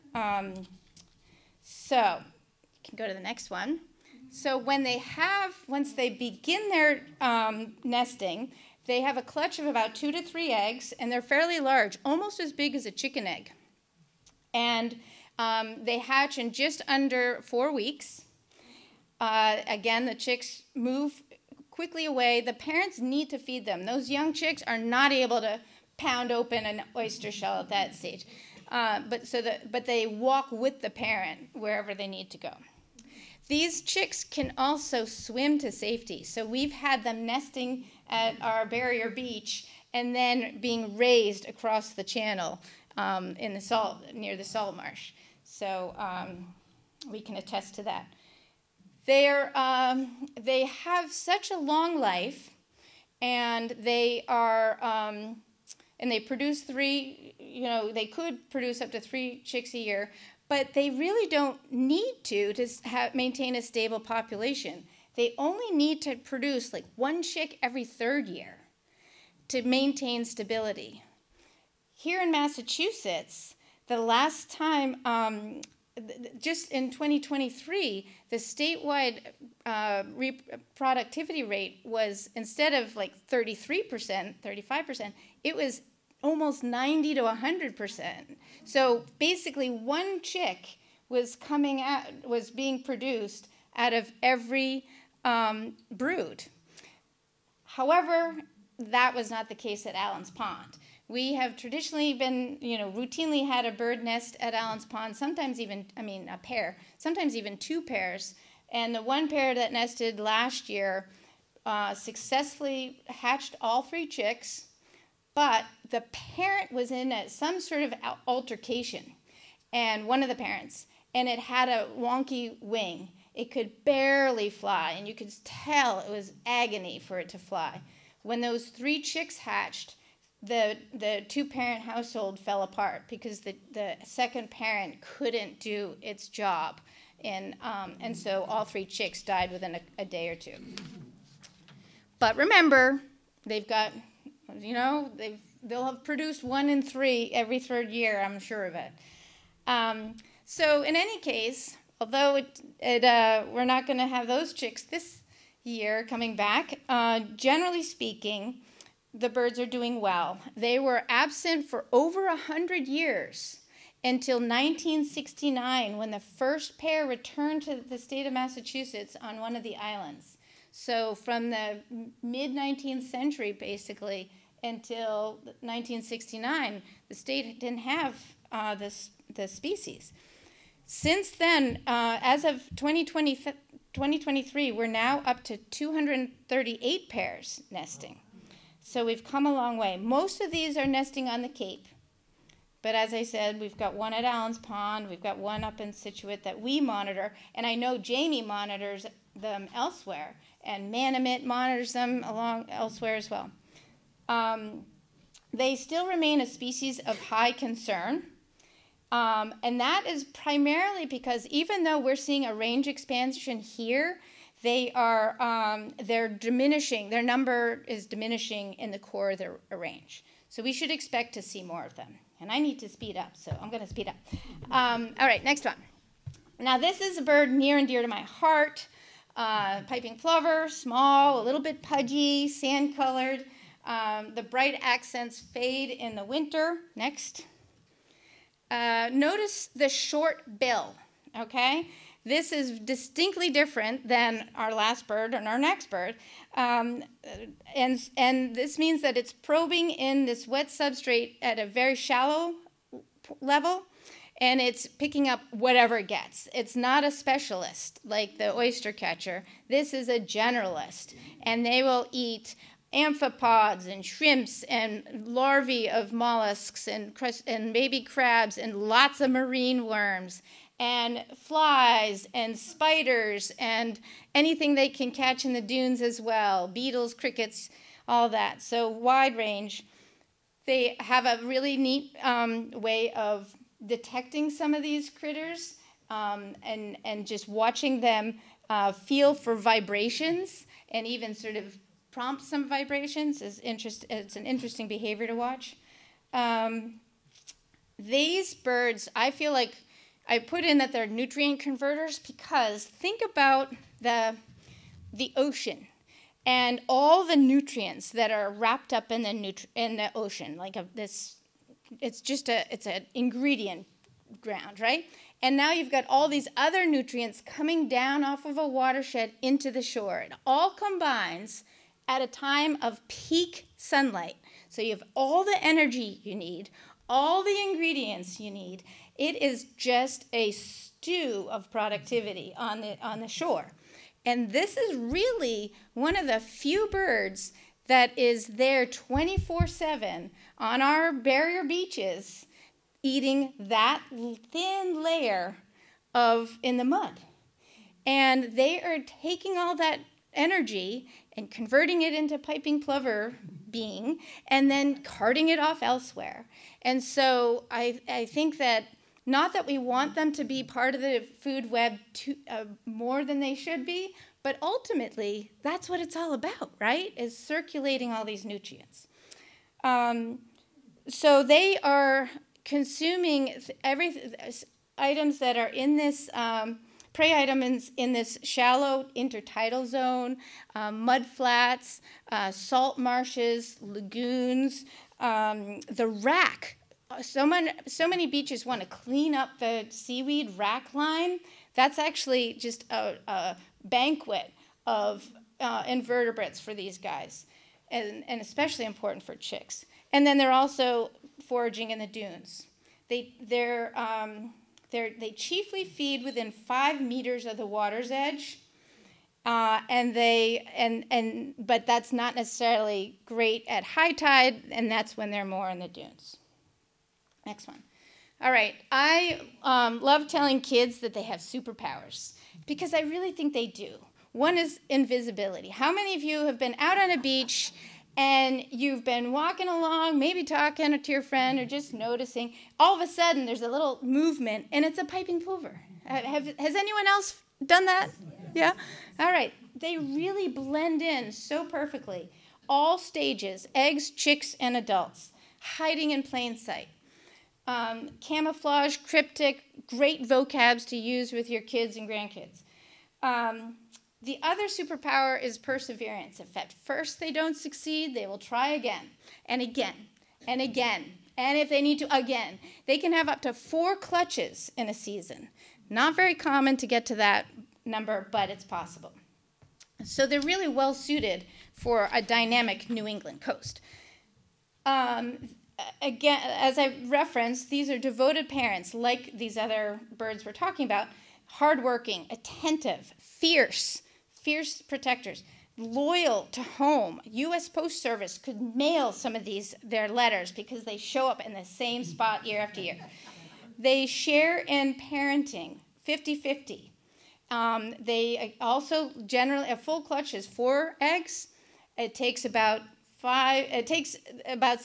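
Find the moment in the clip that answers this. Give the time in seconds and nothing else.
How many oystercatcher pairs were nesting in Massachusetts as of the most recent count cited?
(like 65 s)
185 s.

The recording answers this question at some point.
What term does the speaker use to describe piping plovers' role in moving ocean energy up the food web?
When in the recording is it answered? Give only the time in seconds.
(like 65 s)
301 s.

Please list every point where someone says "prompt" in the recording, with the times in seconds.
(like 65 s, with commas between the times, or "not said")
292 s.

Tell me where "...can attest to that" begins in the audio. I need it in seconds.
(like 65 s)
47 s.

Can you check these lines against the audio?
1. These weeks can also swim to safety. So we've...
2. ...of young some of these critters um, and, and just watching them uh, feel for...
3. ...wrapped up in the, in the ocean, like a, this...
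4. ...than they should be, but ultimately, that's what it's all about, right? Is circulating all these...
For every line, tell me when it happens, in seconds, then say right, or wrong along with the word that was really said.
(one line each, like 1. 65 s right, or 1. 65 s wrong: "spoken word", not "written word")
1. 33 s wrong: "chicks", not "weeks"
2. 283 s wrong: "detecting", not "young"
3. 308 s right
4. 363 s right.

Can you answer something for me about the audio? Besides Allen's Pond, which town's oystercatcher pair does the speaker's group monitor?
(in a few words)
Scituate.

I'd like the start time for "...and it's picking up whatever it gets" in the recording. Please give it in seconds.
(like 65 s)
254 s.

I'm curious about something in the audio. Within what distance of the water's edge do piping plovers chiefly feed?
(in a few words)
5 meters.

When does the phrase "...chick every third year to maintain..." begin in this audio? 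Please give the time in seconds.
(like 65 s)
67 s.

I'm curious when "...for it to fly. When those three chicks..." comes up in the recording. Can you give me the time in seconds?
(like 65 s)
126 s.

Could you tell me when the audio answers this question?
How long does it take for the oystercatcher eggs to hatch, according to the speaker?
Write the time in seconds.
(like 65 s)
16 s.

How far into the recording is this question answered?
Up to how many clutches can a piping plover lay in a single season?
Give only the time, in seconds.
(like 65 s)
463 s.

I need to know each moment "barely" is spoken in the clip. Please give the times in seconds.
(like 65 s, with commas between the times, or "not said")
123 s.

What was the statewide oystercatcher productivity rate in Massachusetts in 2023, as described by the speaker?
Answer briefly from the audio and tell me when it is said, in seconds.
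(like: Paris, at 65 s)
90 to 100%, at 86 s.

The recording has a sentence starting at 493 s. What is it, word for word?
They share in parenting 50 50.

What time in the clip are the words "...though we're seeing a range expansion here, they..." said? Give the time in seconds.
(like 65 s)
211 s.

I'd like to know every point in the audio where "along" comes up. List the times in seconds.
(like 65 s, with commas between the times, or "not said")
202 s, 429 s.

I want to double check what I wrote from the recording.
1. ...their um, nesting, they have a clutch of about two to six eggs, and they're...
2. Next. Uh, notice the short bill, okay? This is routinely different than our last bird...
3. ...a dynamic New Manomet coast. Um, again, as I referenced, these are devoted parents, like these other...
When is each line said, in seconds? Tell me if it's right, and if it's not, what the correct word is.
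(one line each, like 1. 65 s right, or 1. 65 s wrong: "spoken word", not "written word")
1. 6 s wrong: "three", not "six"
2. 236 s wrong: "distinctly", not "routinely"
3. 472 s wrong: "England", not "Manomet".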